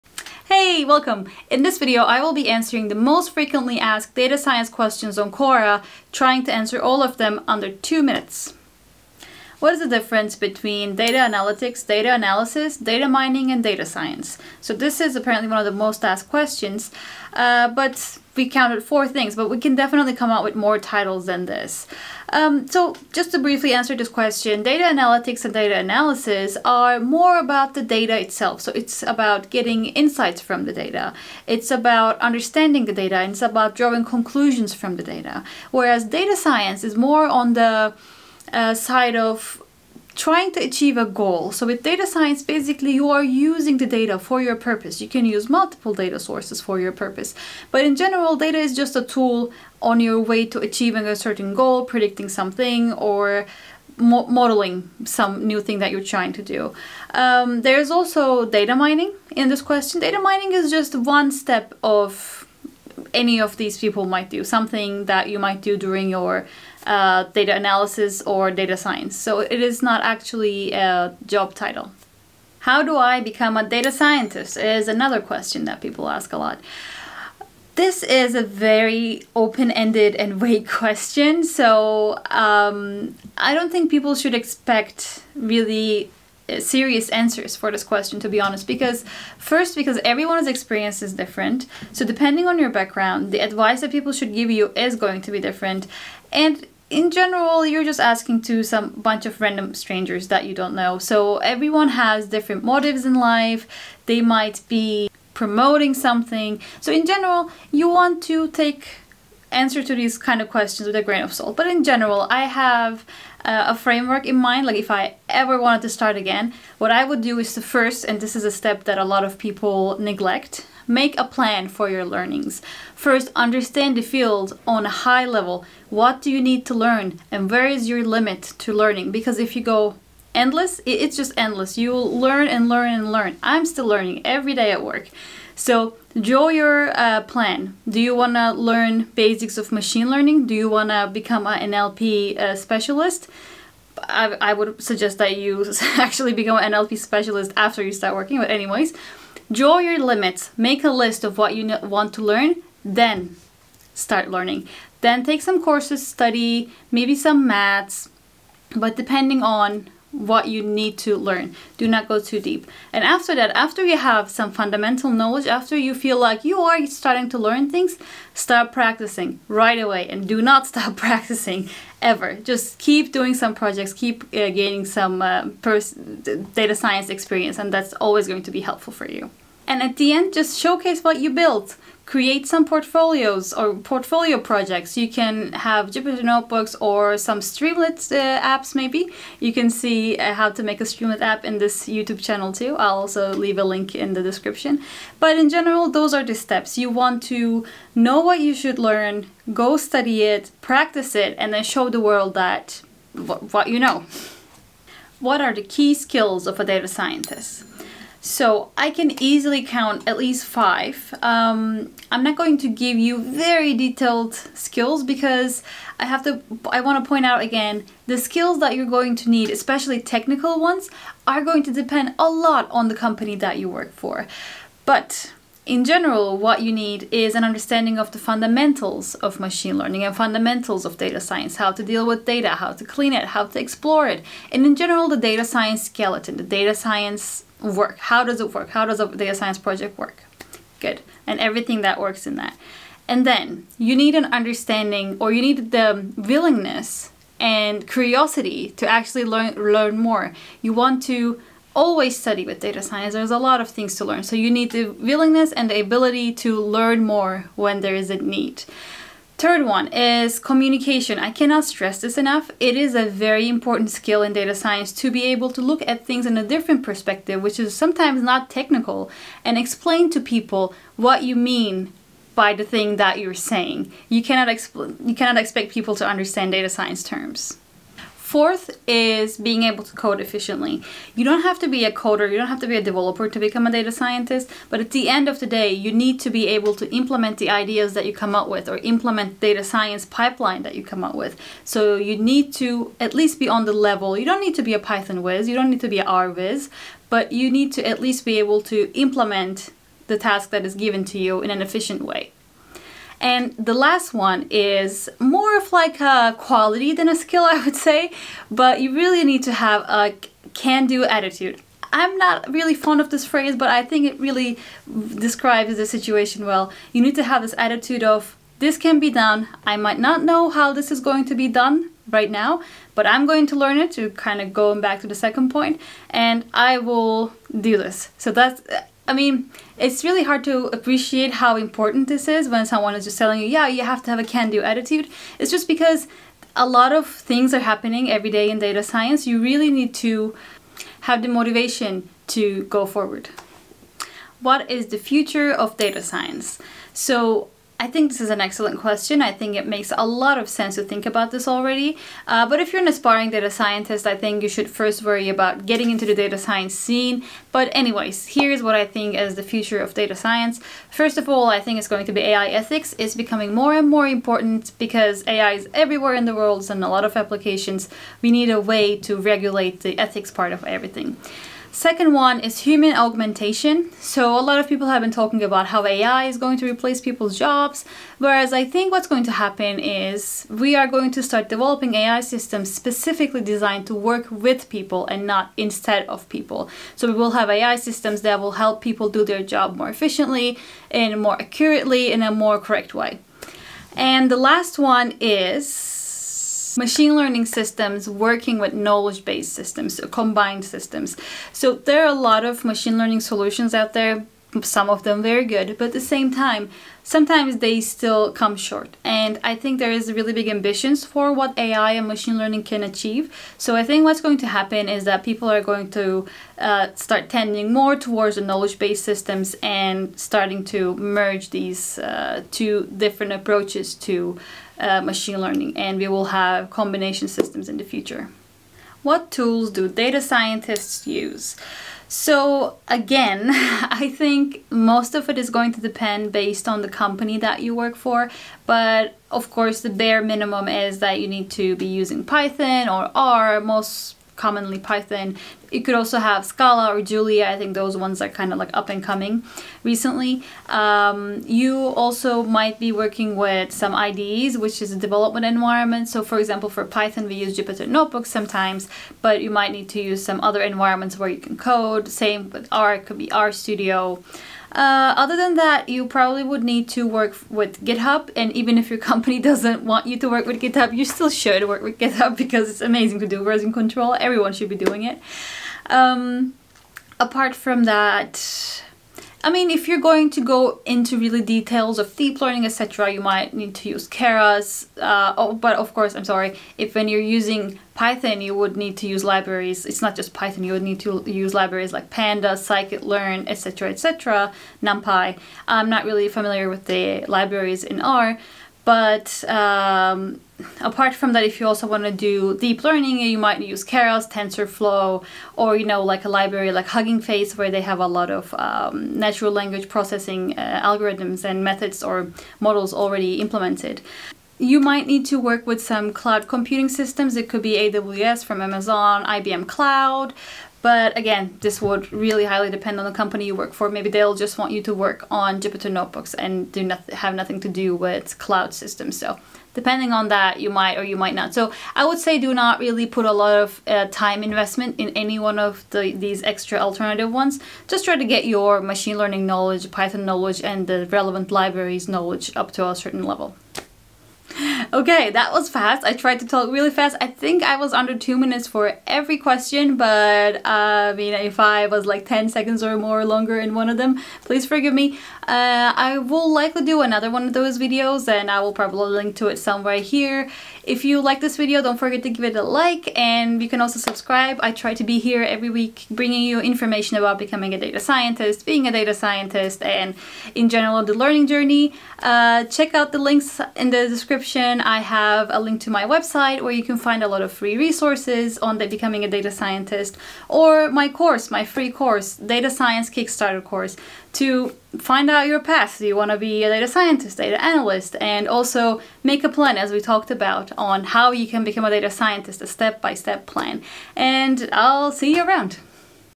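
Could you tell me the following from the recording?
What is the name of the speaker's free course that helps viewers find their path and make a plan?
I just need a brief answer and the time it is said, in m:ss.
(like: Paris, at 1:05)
Data Science Kickstarter, at 9:42.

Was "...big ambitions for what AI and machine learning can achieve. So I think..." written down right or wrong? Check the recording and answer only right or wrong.
right.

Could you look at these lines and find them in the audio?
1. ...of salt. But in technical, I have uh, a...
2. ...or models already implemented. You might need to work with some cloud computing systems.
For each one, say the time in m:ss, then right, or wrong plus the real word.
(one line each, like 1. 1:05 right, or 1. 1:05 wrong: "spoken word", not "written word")
1. 1:51 wrong: "general", not "technical"
2. 8:32 right.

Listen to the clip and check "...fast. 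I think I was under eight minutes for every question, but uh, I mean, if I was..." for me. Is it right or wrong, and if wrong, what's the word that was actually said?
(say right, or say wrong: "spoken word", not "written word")
wrong: "two", not "eight".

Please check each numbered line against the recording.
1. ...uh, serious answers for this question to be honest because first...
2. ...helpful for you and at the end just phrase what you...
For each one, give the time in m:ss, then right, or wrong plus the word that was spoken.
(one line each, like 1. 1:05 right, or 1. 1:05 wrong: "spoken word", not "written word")
1. 1:26 right
2. 2:58 wrong: "showcase", not "phrase".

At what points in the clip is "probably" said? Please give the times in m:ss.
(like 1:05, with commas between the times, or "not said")
7:46, 9:18.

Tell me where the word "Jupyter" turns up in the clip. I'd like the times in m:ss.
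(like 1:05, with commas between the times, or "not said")
3:05, 7:37, 8:45.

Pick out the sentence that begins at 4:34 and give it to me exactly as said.
You cannot, expl- you cannot expect people to understand data science terms.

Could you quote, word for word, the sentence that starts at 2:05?
What do you need to learn and where is your limit to learning?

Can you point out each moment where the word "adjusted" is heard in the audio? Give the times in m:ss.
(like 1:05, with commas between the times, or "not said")
not said.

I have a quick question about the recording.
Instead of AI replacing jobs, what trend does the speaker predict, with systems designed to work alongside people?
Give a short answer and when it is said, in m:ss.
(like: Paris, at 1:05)
Human augmentation, at 6:12.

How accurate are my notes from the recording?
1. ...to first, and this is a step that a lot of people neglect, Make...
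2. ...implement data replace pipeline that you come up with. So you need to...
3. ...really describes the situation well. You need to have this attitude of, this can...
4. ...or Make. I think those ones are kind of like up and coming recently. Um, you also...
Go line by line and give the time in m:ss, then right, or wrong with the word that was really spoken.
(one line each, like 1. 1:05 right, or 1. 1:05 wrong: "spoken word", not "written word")
1. 1:57 right
2. 4:48 wrong: "science", not "replace"
3. 5:14 right
4. 7:26 wrong: "Julia", not "Make".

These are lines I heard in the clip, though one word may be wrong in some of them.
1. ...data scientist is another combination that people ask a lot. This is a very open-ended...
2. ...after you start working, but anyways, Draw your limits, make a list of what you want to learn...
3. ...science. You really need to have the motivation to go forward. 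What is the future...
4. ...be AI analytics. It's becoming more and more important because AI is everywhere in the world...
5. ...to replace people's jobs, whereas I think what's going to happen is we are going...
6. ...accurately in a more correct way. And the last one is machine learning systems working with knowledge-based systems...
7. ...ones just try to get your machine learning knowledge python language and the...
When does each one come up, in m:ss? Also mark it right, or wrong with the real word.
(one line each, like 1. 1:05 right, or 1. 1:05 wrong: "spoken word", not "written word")
1. 1:13 wrong: "question", not "combination"
2. 2:27 right
3. 5:38 right
4. 6:02 wrong: "ethics", not "analytics"
5. 6:16 right
6. 6:31 right
7. 8:57 wrong: "knowledge", not "language".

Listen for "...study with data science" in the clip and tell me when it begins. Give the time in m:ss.
4:12.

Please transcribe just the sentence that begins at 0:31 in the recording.
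It's about understanding the data and it's about drawing conclusions from the data.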